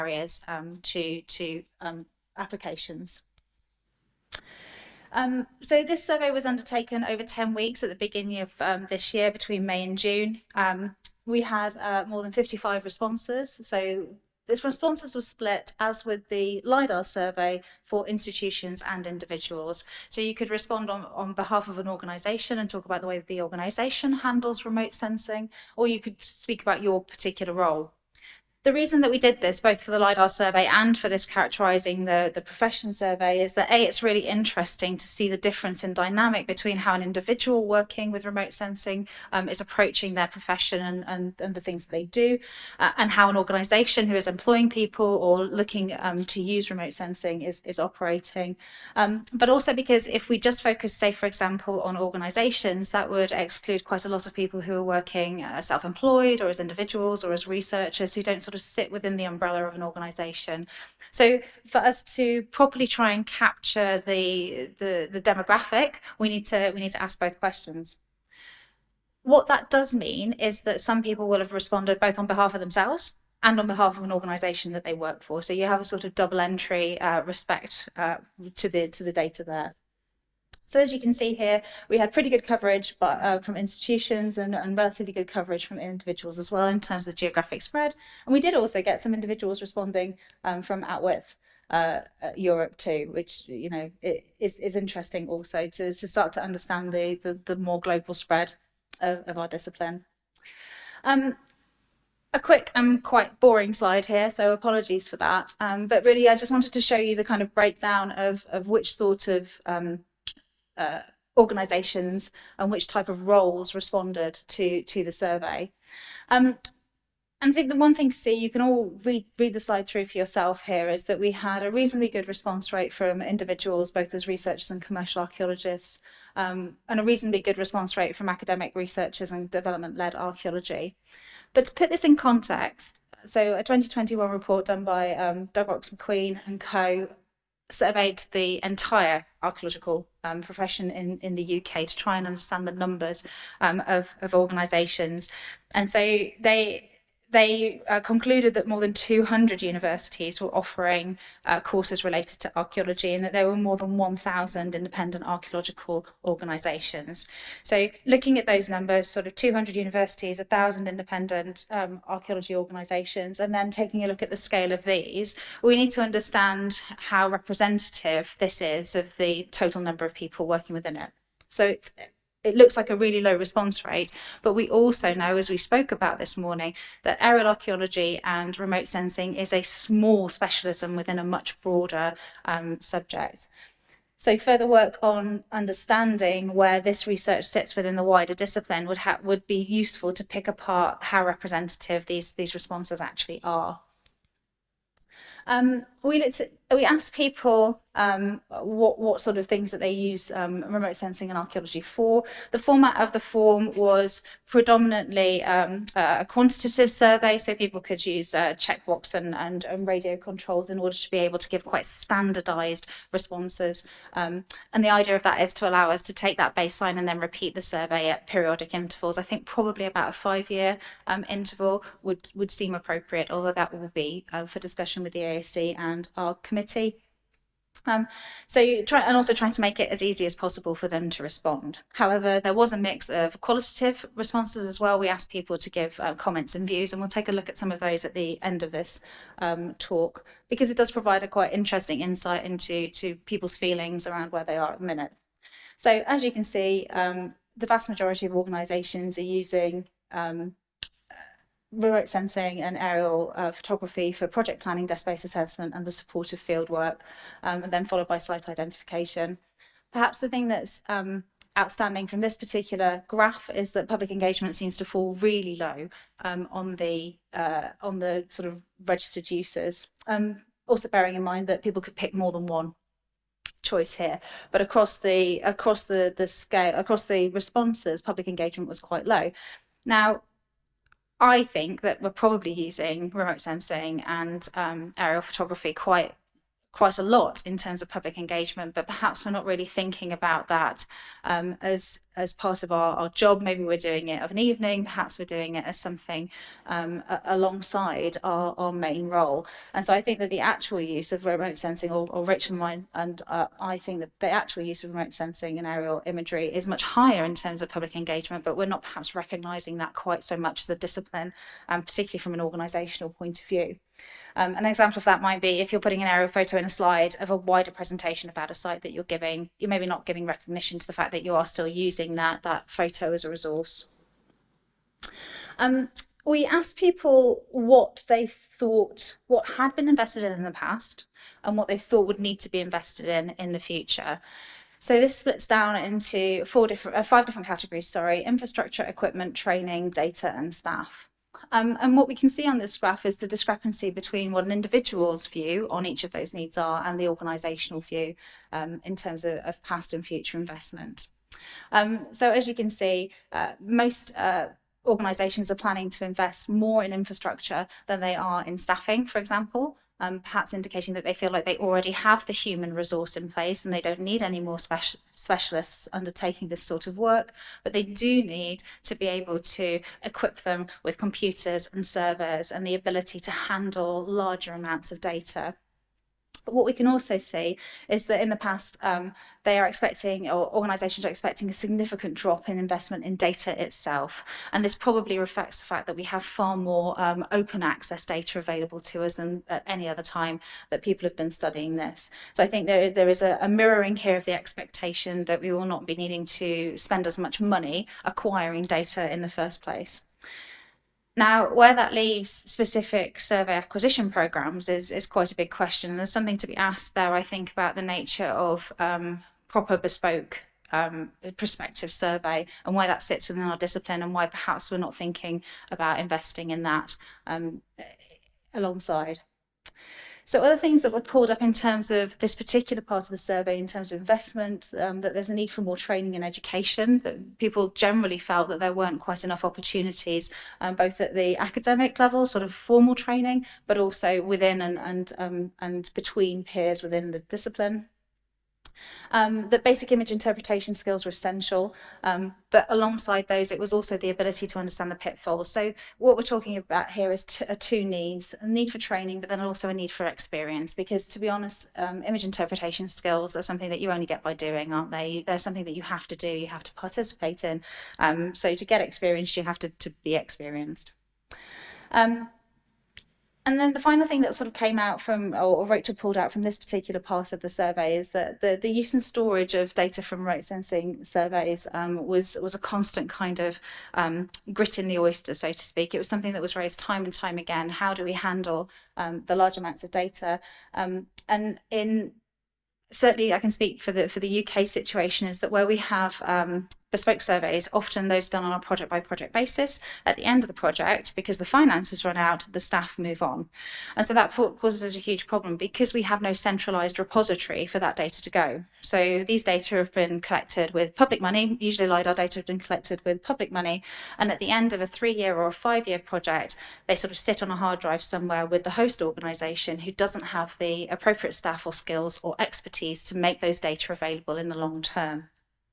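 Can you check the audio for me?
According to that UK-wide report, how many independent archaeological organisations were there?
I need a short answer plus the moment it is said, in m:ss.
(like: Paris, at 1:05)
more than 1,000, at 2:33.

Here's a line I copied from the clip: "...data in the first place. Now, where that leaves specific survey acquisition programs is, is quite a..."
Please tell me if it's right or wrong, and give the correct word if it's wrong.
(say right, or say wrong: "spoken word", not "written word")
right.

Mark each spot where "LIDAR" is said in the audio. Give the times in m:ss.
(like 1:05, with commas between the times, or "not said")
0:16, 0:29, 8:21.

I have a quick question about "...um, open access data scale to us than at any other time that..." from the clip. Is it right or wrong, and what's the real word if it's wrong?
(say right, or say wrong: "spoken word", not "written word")
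wrong: "available", not "scale".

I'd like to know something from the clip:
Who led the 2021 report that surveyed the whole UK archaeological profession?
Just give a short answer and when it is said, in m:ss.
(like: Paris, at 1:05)
Doug Rocks-Macqueen, at 2:15.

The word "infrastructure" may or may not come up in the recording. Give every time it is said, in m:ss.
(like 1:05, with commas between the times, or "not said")
5:38, 5:56.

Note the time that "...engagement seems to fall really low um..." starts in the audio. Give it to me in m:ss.
4:24.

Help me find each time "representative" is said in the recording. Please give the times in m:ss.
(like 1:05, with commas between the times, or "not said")
2:47, 3:11.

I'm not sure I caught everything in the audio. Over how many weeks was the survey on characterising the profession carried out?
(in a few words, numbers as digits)
10 weeks.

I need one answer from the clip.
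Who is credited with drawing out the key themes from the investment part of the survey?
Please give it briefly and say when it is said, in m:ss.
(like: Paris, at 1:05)
Rachel, at 7:45.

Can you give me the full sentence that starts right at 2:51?
So, it's it looks like a really low response rate.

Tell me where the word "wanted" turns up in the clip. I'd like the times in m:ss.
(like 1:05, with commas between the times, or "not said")
1:46.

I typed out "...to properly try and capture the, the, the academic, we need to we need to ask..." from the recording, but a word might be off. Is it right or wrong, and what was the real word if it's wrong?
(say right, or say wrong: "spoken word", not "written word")
wrong: "demographic", not "academic".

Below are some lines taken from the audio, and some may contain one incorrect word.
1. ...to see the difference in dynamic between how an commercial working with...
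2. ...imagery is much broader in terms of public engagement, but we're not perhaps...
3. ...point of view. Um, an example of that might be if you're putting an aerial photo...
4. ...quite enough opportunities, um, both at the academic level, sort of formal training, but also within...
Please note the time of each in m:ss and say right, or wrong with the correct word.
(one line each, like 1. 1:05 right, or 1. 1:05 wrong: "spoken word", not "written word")
1. 0:34 wrong: "individual", not "commercial"
2. 5:06 wrong: "higher", not "broader"
3. 5:13 right
4. 7:09 right.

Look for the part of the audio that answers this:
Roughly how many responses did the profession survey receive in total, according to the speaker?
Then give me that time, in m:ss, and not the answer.
0:12.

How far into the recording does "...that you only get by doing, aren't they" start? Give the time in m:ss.
7:33.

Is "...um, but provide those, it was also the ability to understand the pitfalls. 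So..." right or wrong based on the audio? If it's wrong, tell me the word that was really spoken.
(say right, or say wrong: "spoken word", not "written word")
wrong: "alongside", not "provide".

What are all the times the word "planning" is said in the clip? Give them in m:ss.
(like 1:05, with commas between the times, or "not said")
4:14, 5:55.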